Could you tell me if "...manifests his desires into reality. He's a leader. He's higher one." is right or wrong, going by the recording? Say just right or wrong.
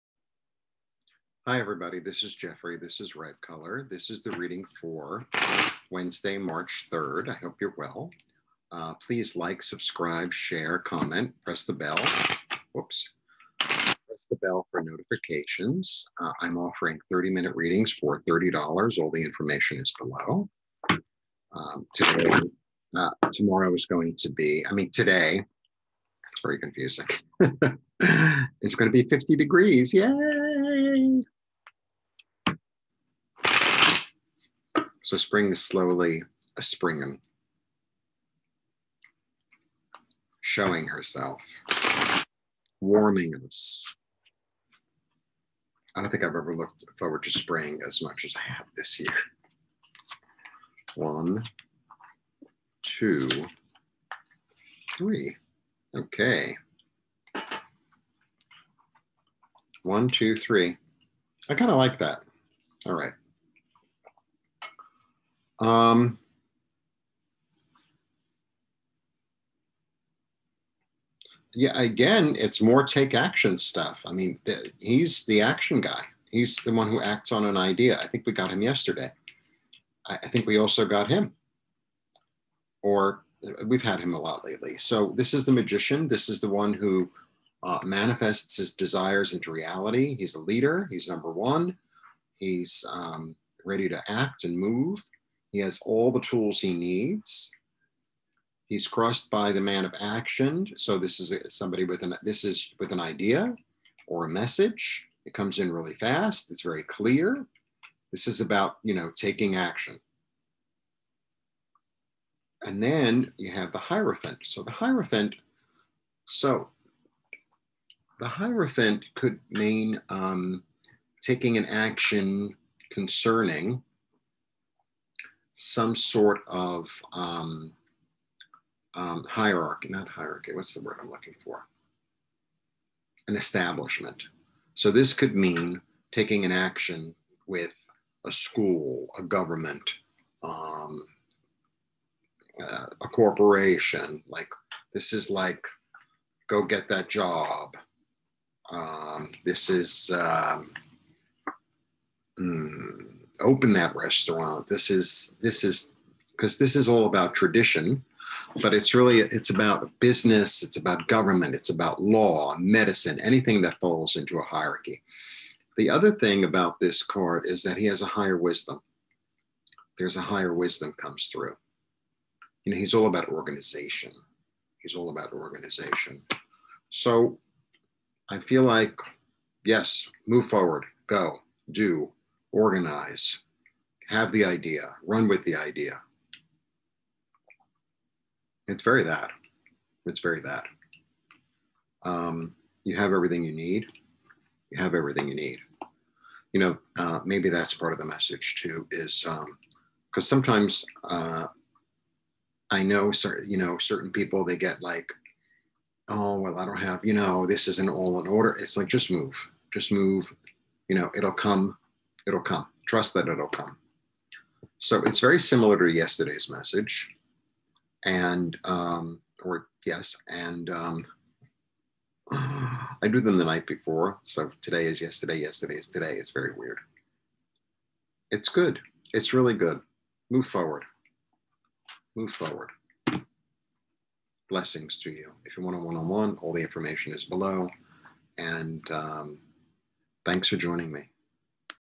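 wrong.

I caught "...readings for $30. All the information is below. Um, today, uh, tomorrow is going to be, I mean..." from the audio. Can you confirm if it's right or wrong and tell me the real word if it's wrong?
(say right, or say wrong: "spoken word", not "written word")
right.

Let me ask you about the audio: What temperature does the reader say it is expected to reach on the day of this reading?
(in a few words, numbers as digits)
50 degrees.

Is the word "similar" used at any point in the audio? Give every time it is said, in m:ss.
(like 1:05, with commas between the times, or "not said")
3:35.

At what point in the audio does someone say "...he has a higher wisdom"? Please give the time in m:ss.
2:47.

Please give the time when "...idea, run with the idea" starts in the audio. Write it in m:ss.
3:04.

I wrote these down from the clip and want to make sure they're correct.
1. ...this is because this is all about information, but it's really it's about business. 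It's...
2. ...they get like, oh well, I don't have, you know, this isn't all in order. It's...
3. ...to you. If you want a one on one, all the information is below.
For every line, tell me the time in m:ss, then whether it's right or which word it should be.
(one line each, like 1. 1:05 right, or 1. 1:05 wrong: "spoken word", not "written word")
1. 2:35 wrong: "tradition", not "information"
2. 3:24 right
3. 3:54 right.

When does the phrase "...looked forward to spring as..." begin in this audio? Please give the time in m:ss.
0:46.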